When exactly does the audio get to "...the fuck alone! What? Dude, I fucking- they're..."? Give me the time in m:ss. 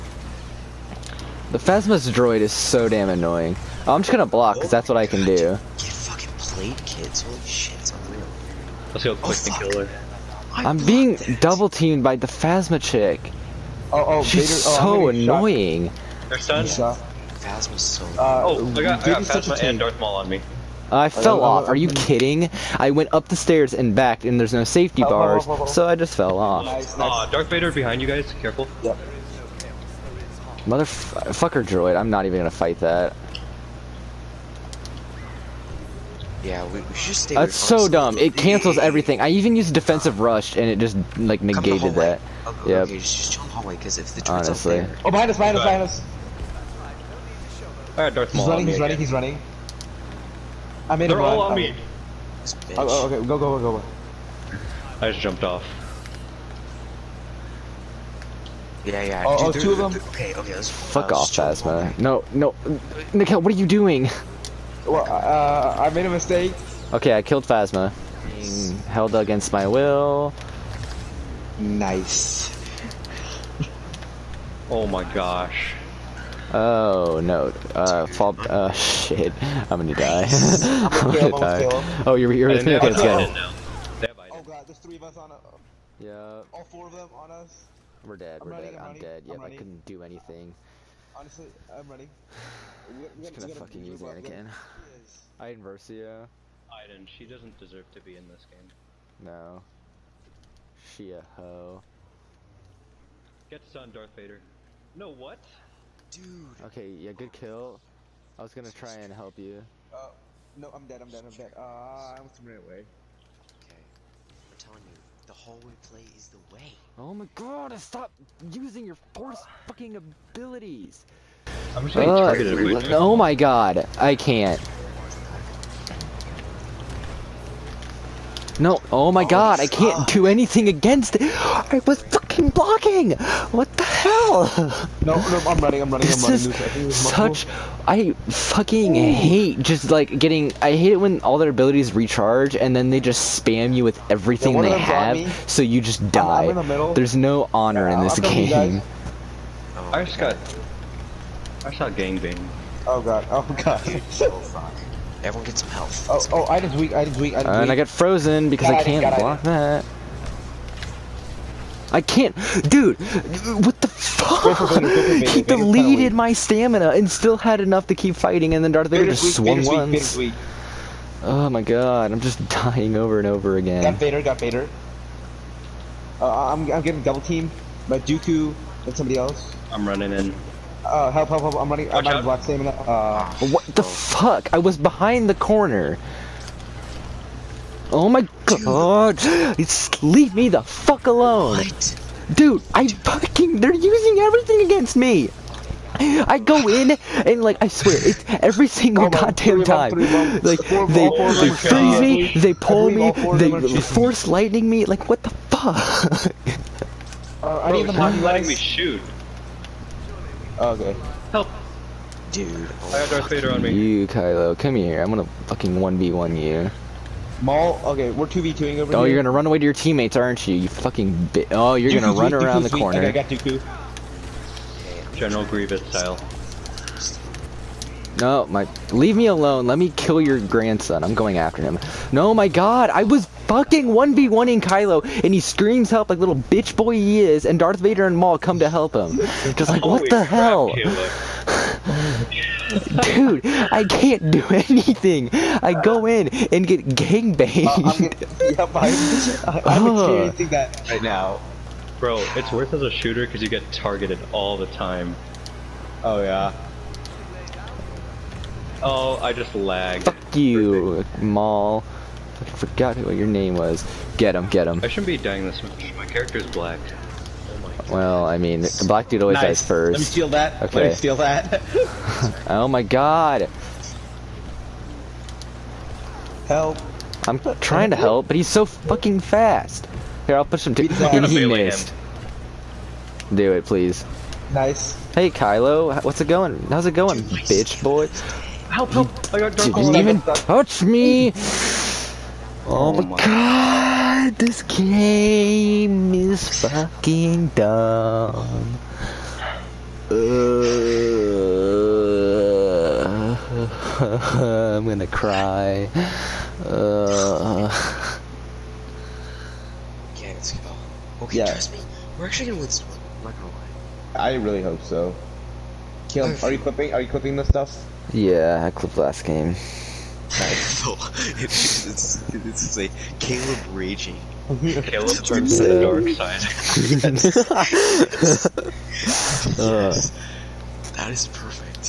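3:10.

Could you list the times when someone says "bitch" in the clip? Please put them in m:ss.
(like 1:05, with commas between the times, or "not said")
3:56, 4:47.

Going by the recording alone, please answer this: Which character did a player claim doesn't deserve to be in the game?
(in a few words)
Iden Versio.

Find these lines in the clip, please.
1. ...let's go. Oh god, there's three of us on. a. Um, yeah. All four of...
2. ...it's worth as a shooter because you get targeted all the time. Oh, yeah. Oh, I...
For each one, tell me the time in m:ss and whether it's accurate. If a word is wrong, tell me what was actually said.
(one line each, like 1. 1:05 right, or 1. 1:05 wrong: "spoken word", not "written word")
1. 1:22 right
2. 4:12 right.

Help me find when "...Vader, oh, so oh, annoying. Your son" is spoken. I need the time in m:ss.
0:14.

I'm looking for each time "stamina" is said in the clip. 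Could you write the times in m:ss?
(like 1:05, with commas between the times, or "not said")
2:46, 3:02.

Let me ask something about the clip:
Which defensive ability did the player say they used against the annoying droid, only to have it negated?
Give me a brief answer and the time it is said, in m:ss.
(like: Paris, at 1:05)
Defensive rush, at 0:39.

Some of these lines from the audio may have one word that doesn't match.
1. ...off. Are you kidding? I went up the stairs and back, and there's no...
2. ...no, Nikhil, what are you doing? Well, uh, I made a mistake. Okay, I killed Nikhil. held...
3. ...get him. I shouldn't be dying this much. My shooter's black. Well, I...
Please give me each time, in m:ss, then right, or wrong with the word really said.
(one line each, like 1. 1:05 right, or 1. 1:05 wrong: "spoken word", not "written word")
1. 0:21 right
2. 1:02 wrong: "Phasma", not "Nikhil"
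3. 4:24 wrong: "character", not "shooter".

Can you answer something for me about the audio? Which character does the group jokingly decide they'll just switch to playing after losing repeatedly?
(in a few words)
Anakin.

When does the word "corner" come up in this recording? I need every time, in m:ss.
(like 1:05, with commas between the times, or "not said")
3:05, 3:42.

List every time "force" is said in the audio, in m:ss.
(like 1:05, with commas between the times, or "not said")
1:58, 3:23.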